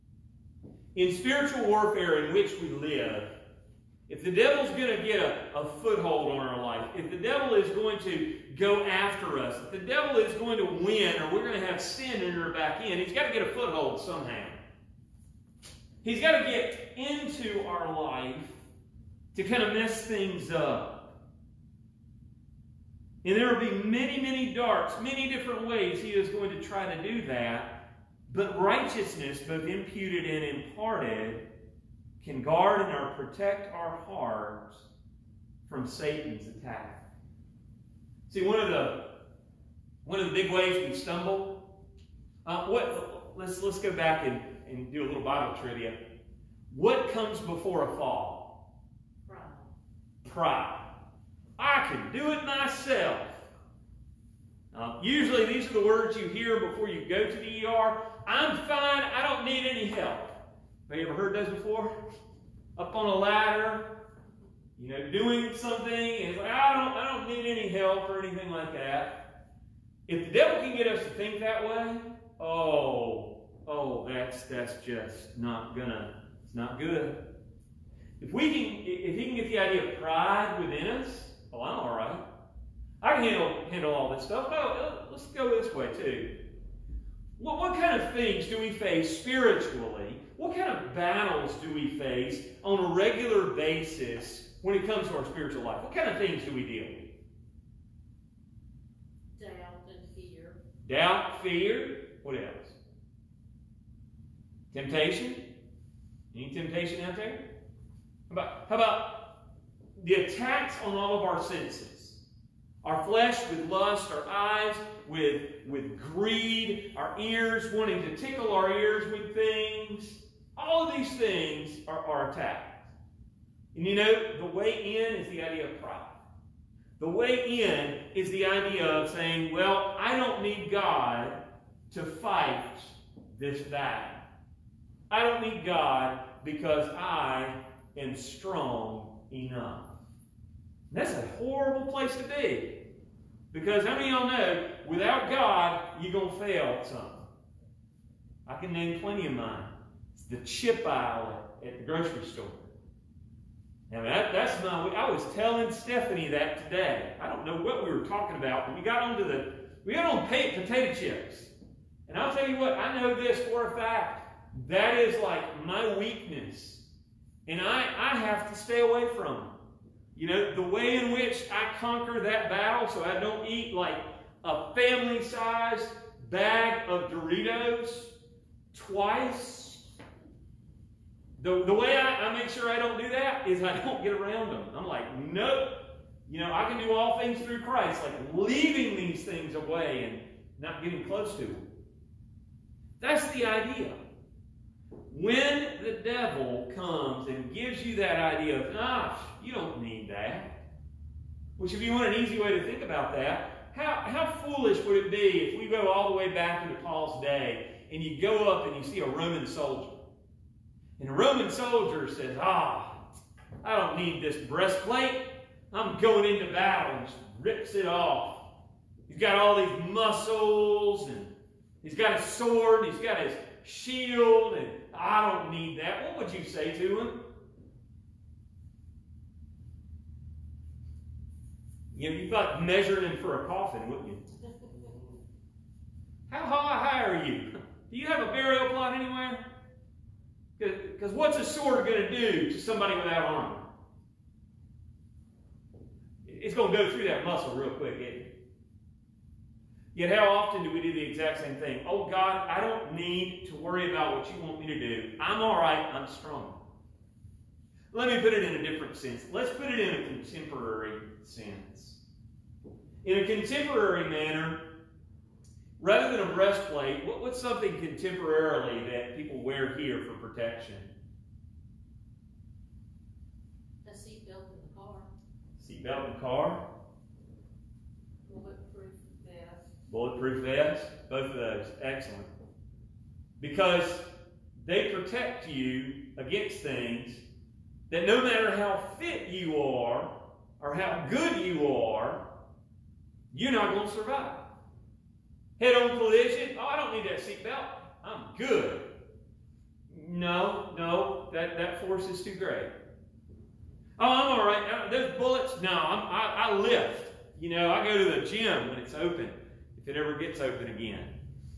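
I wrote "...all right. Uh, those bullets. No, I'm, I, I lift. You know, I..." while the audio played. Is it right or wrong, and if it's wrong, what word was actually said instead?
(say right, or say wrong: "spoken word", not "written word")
right.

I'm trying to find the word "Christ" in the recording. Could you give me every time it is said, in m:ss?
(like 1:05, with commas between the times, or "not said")
3:07.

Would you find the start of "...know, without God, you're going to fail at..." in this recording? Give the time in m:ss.
2:24.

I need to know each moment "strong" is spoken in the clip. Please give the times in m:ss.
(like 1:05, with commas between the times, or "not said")
2:18, 4:16.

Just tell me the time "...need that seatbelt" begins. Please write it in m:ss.
4:56.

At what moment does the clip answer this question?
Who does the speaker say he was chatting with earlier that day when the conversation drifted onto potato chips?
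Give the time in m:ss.
2:35.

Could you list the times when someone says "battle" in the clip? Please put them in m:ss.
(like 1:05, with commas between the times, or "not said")
1:30, 2:13, 2:52, 3:36.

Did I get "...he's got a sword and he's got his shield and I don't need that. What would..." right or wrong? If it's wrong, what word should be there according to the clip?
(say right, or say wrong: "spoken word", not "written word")
right.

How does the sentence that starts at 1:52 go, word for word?
Our flesh with lust, our eyes with, with greed, our ears wanting to tickle our ears with things.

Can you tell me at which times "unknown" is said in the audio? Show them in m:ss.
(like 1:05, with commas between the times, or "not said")
not said.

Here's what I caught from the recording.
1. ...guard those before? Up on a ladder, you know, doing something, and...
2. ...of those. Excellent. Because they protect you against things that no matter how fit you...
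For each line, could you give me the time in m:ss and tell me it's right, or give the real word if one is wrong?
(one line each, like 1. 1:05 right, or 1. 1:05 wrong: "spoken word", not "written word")
1. 1:01 wrong: "heard", not "guard"
2. 4:41 right.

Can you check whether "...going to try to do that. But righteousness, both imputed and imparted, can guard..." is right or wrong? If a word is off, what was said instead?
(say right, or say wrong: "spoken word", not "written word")
right.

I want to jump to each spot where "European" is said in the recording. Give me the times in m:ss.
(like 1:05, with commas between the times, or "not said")
not said.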